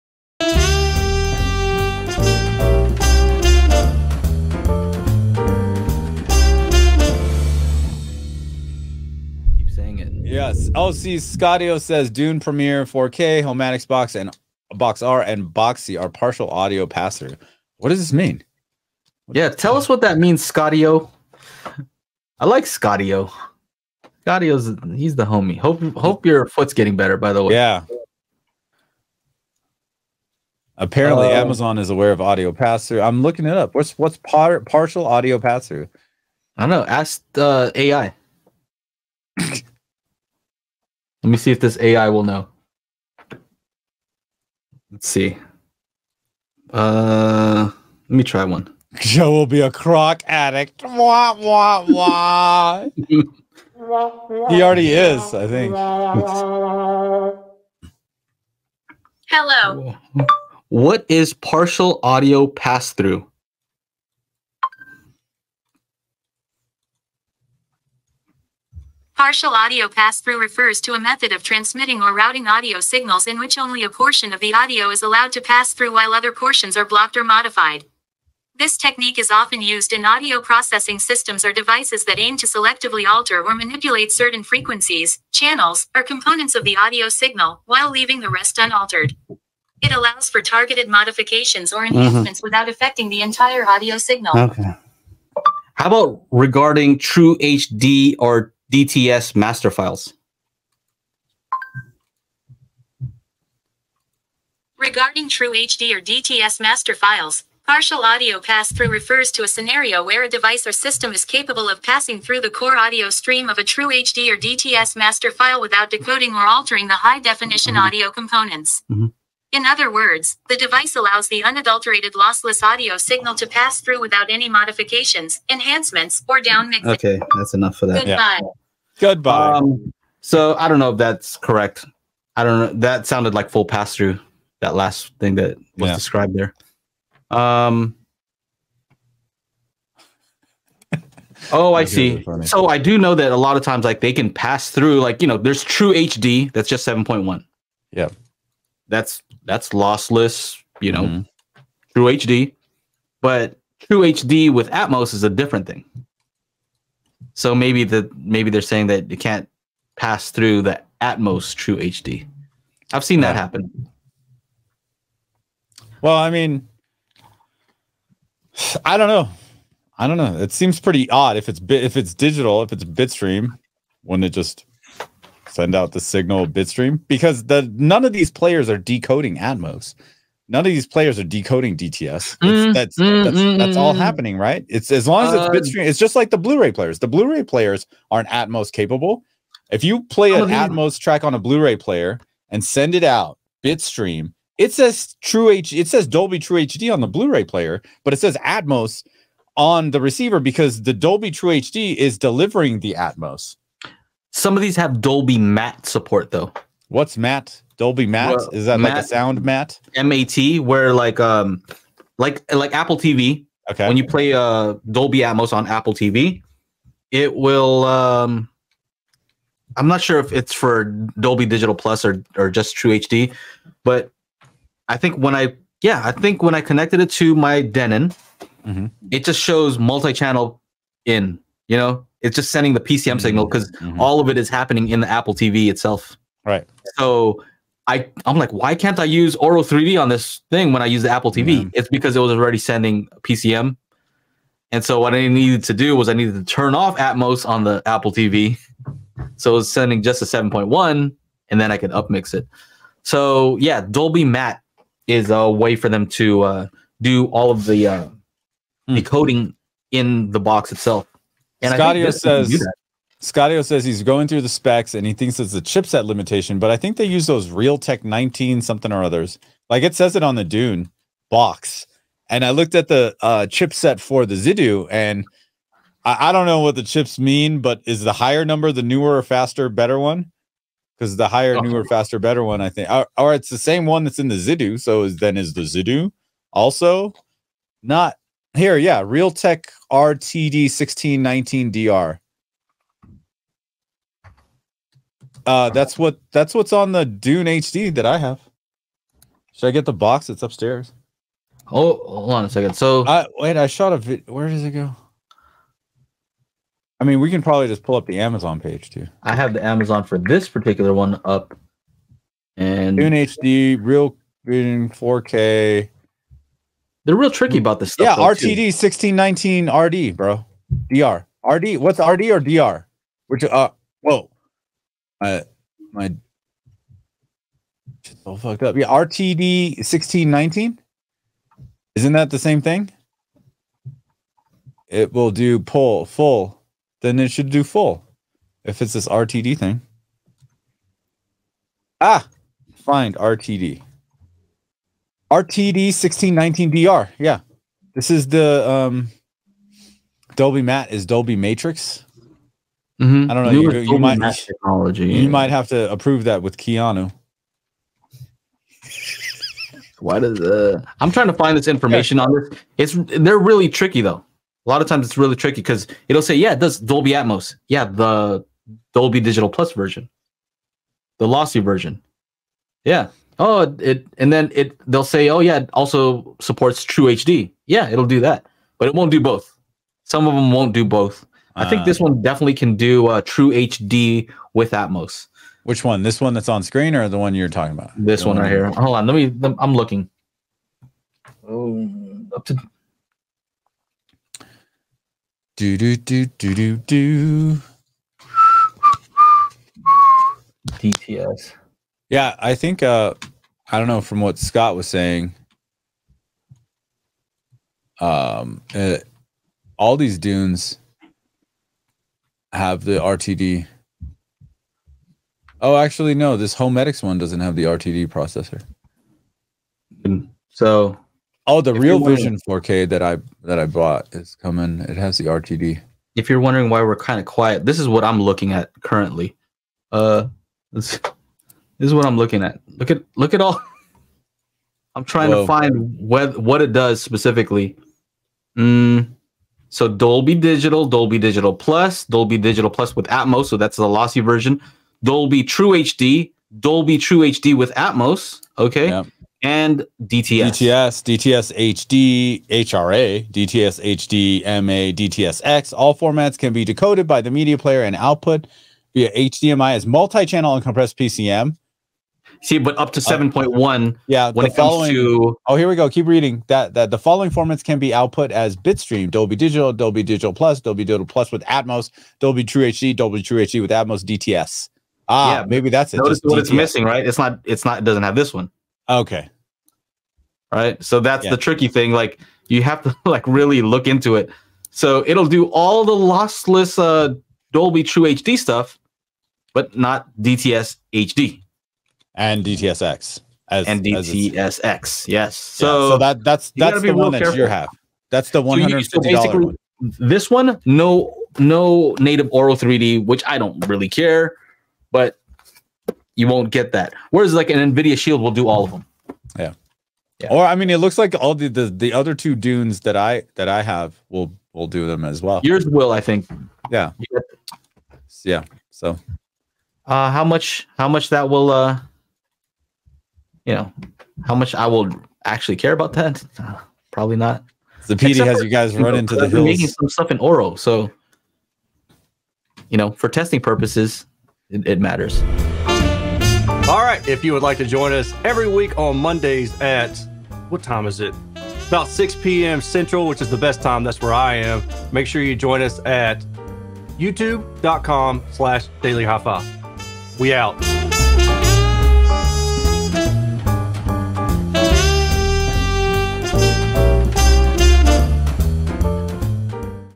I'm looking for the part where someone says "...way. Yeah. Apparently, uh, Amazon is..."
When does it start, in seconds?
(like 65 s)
27 s.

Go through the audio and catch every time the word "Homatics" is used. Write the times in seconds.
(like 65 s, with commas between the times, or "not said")
13 s, 416 s.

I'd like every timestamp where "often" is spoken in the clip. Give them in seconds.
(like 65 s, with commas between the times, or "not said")
79 s.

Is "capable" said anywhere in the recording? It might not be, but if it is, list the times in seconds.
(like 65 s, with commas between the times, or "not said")
111 s, 188 s.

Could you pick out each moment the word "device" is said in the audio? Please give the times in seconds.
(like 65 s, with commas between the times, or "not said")
81 s, 110 s, 120 s.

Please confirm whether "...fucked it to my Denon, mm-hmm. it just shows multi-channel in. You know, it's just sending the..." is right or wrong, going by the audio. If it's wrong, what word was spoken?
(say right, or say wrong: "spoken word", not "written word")
wrong: "connected", not "fucked".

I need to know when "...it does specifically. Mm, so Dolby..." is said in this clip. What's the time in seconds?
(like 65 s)
436 s.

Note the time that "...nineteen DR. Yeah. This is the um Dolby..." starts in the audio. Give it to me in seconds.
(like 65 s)
346 s.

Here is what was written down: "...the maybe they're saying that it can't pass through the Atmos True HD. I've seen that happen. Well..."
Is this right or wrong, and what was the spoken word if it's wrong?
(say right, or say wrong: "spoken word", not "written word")
right.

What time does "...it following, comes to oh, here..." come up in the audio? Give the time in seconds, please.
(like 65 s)
464 s.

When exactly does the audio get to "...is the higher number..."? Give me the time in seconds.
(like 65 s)
277 s.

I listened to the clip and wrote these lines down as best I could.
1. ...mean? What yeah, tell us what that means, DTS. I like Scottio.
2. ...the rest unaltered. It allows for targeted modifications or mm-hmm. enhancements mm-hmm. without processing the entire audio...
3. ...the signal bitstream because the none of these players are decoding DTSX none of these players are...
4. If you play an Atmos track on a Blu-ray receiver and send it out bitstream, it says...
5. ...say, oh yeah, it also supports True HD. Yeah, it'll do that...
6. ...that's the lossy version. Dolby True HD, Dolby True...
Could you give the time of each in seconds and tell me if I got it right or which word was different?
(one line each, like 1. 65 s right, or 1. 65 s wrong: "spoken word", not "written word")
1. 18 s wrong: "Scottio", not "DTS"
2. 88 s wrong: "affecting", not "processing"
3. 175 s wrong: "Atmos", not "DTSX"
4. 189 s wrong: "player", not "receiver"
5. 375 s right
6. 443 s right.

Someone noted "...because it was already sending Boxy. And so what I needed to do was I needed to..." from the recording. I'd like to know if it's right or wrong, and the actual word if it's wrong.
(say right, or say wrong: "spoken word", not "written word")
wrong: "PCM", not "Boxy".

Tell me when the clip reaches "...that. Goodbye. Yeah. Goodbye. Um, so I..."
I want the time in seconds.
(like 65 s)
127 s.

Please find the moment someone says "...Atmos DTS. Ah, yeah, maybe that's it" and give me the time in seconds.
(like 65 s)
473 s.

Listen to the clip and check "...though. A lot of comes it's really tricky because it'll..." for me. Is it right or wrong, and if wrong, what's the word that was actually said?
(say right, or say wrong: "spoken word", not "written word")
wrong: "times", not "comes".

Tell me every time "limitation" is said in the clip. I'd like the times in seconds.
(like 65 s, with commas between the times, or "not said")
266 s.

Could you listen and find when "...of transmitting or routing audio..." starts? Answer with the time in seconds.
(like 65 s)
71 s.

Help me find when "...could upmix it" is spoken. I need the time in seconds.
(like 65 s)
251 s.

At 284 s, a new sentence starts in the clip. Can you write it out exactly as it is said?
So is, then is the Zidoo also not here?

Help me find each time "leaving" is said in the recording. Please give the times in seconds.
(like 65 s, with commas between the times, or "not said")
87 s.